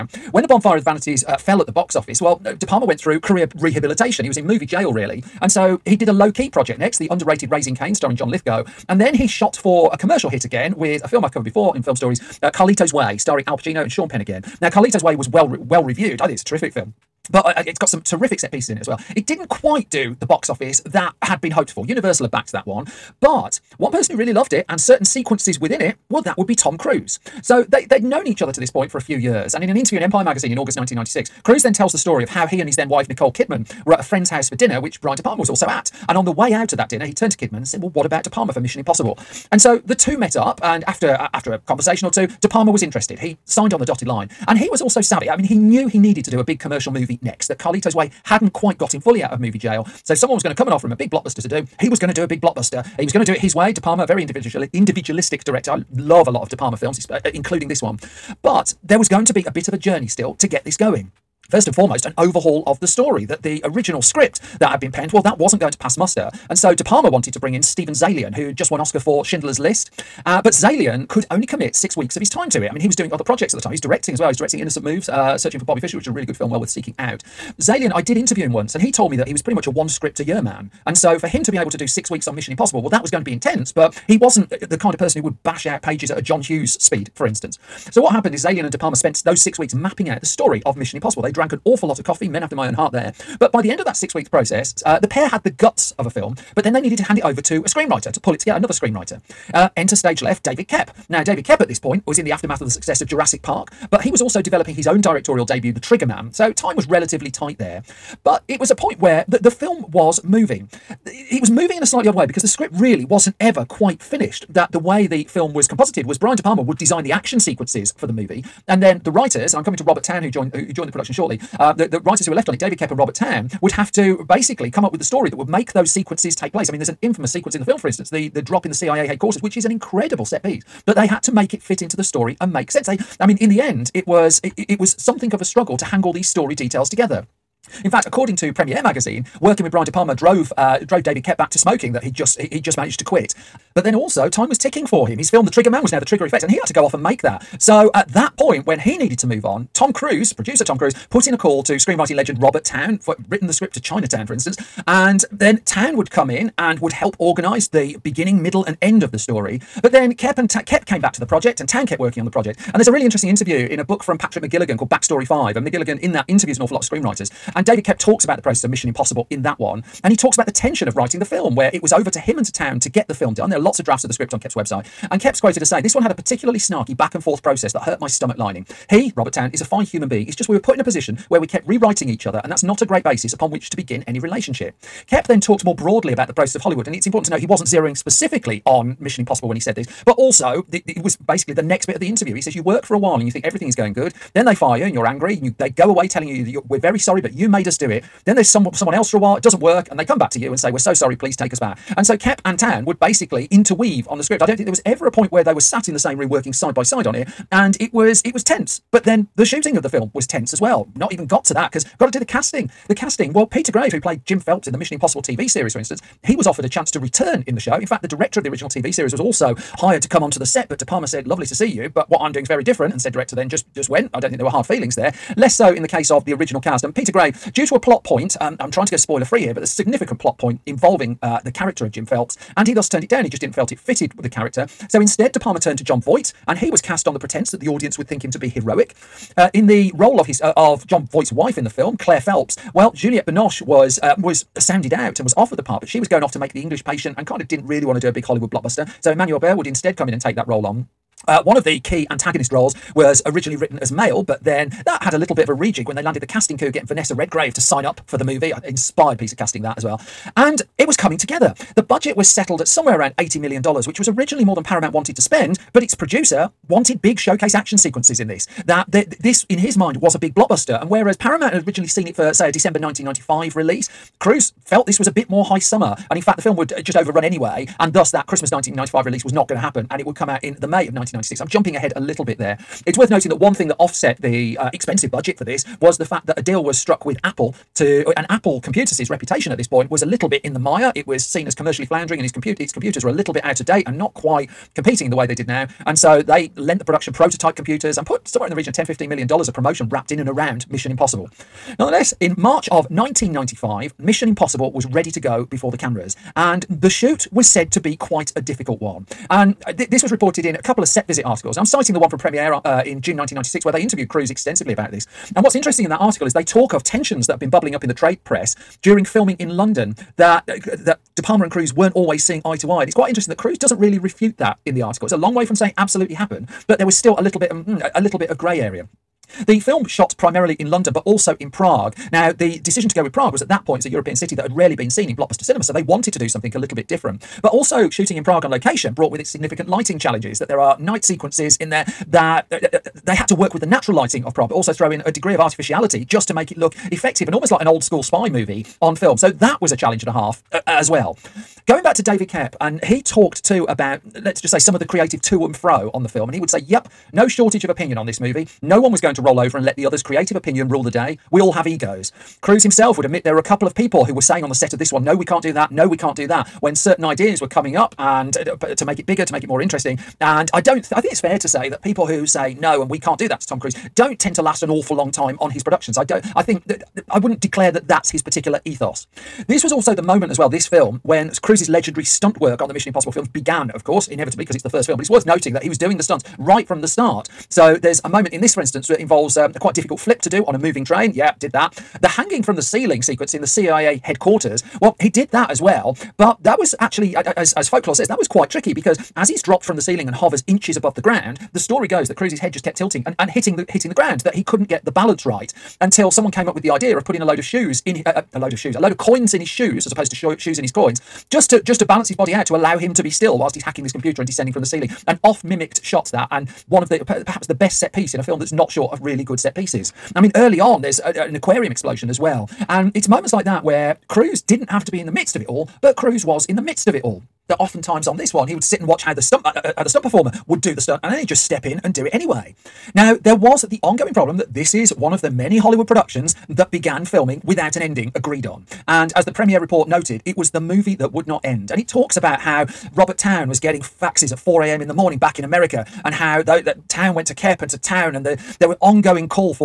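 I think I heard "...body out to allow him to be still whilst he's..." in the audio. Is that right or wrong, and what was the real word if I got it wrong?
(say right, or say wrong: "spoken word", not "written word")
right.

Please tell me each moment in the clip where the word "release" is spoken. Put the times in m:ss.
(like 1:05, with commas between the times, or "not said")
4:33, 4:39.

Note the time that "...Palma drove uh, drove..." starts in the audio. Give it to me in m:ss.
2:19.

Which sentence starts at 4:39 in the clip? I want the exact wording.
And it would come out in the May of 1996.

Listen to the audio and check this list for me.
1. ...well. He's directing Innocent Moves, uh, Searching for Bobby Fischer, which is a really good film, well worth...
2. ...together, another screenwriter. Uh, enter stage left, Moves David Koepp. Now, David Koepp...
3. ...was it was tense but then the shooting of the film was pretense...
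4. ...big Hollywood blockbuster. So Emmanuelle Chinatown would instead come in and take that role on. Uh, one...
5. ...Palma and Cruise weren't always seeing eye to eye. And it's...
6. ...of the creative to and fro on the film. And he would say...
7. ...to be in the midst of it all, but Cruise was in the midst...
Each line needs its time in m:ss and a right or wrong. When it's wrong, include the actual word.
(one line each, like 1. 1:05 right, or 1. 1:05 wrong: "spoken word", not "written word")
1. 1:14 right
2. 1:38 wrong: "David", not "Moves"
3. 3:27 wrong: "tense", not "pretense"
4. 4:08 wrong: "Béart", not "Chinatown"
5. 5:21 right
6. 5:54 right
7. 7:04 right.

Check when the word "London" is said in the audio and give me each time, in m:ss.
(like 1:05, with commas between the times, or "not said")
5:19, 5:30.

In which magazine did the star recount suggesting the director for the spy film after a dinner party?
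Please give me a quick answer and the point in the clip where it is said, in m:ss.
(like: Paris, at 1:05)
Empire, at 0:30.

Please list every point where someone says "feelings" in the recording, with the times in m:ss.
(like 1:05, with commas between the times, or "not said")
3:44.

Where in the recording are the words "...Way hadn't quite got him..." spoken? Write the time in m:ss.
0:47.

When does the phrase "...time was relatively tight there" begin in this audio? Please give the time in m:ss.
1:46.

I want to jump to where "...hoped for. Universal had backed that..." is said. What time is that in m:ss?
0:21.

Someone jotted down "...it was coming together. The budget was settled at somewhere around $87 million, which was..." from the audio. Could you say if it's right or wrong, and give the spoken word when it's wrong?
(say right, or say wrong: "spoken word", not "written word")
wrong: "80", not "87".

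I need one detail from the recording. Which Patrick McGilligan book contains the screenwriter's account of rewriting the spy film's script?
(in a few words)
Backstory 5.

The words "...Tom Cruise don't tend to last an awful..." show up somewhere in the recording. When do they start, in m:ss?
6:13.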